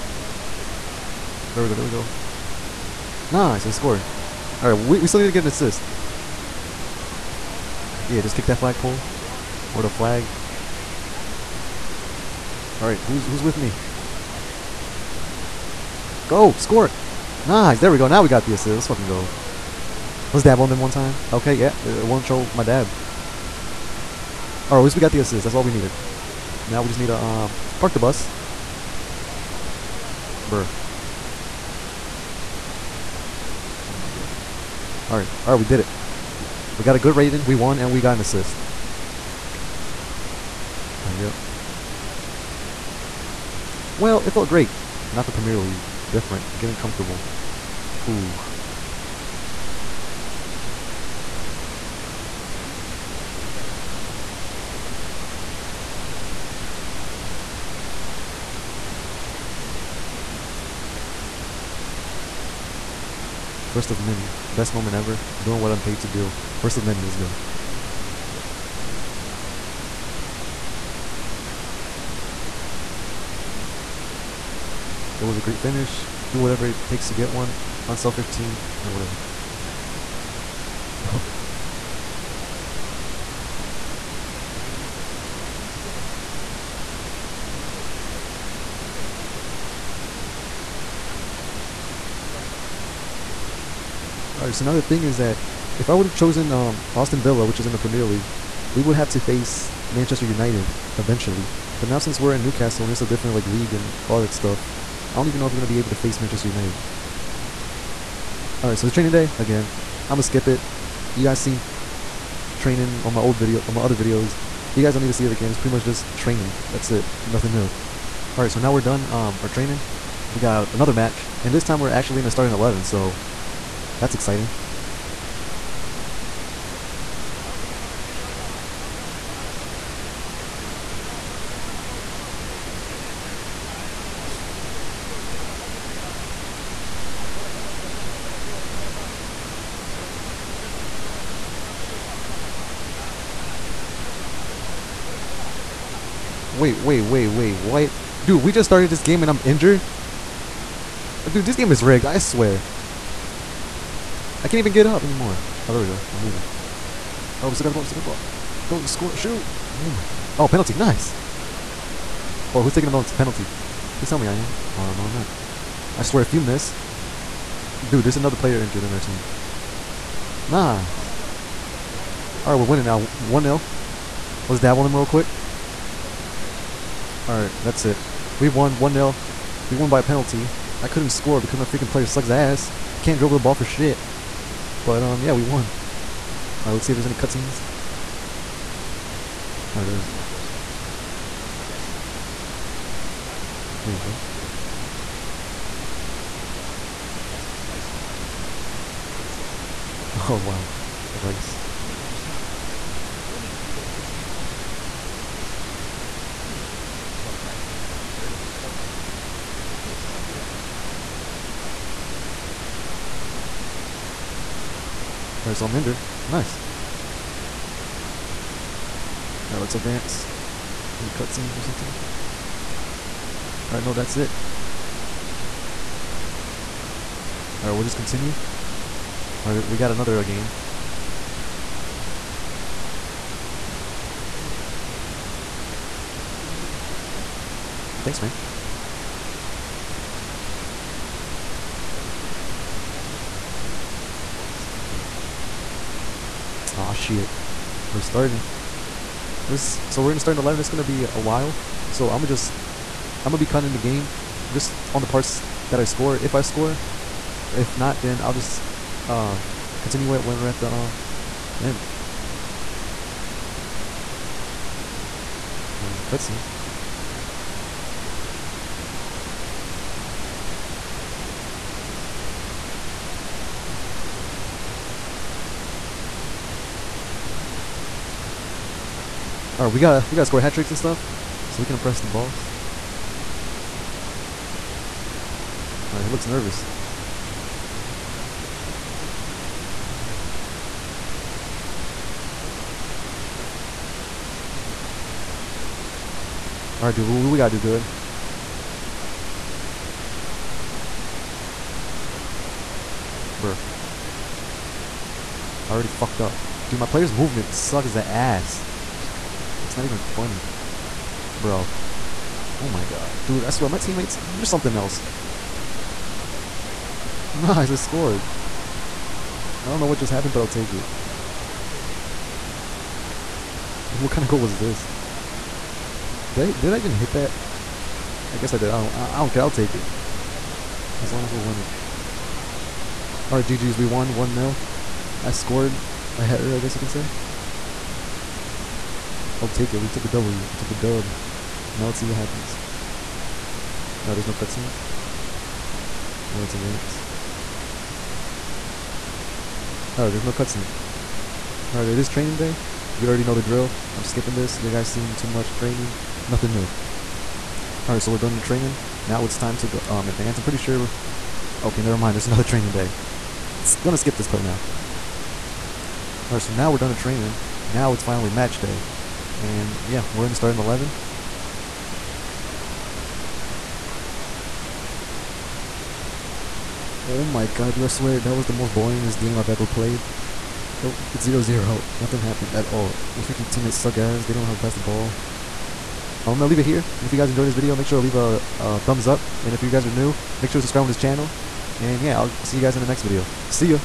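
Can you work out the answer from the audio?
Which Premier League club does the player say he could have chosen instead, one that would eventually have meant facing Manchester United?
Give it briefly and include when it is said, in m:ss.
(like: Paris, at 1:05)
Aston Villa, at 1:36.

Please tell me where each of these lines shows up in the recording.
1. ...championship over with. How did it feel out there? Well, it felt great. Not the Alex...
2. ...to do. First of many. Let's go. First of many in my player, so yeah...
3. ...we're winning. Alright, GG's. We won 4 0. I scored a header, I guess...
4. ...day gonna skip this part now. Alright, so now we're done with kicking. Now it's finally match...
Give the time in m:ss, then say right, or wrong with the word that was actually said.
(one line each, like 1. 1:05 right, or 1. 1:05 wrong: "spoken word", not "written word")
1. 0:41 wrong: "Premier", not "Alex"
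2. 1:05 wrong: "career", not "player"
3. 5:31 wrong: "1", not "4"
4. 6:02 wrong: "training", not "kicking".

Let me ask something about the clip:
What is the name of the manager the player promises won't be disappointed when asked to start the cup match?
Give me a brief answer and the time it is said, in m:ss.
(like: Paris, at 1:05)
Dino, at 4:04.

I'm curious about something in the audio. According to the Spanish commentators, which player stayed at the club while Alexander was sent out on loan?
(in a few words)
Walker.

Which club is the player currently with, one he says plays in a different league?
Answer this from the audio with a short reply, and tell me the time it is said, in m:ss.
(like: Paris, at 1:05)
Newcastle, at 1:42.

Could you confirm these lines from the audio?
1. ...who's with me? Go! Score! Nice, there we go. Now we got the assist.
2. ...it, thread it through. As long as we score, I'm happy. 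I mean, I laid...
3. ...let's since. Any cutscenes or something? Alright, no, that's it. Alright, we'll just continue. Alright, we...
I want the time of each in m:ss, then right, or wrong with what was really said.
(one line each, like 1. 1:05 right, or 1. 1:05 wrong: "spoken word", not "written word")
1. 0:13 right
2. 1:24 right
3. 3:39 wrong: "advance", not "since".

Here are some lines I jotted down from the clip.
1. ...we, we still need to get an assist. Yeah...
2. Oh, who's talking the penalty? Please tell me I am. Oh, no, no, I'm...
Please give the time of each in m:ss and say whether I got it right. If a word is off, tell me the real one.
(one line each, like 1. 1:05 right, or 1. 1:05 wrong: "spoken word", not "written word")
1. 0:04 right
2. 2:42 wrong: "taking", not "talking".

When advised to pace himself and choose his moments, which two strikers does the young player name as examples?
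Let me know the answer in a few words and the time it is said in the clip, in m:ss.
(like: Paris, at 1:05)
Ibrahimovic, Berbatov, at 3:28.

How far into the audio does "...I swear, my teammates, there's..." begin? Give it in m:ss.
5:13.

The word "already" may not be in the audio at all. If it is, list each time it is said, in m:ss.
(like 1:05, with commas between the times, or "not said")
1:00, 5:05, 5:53.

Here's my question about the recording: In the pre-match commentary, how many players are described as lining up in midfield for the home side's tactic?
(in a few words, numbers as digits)
5.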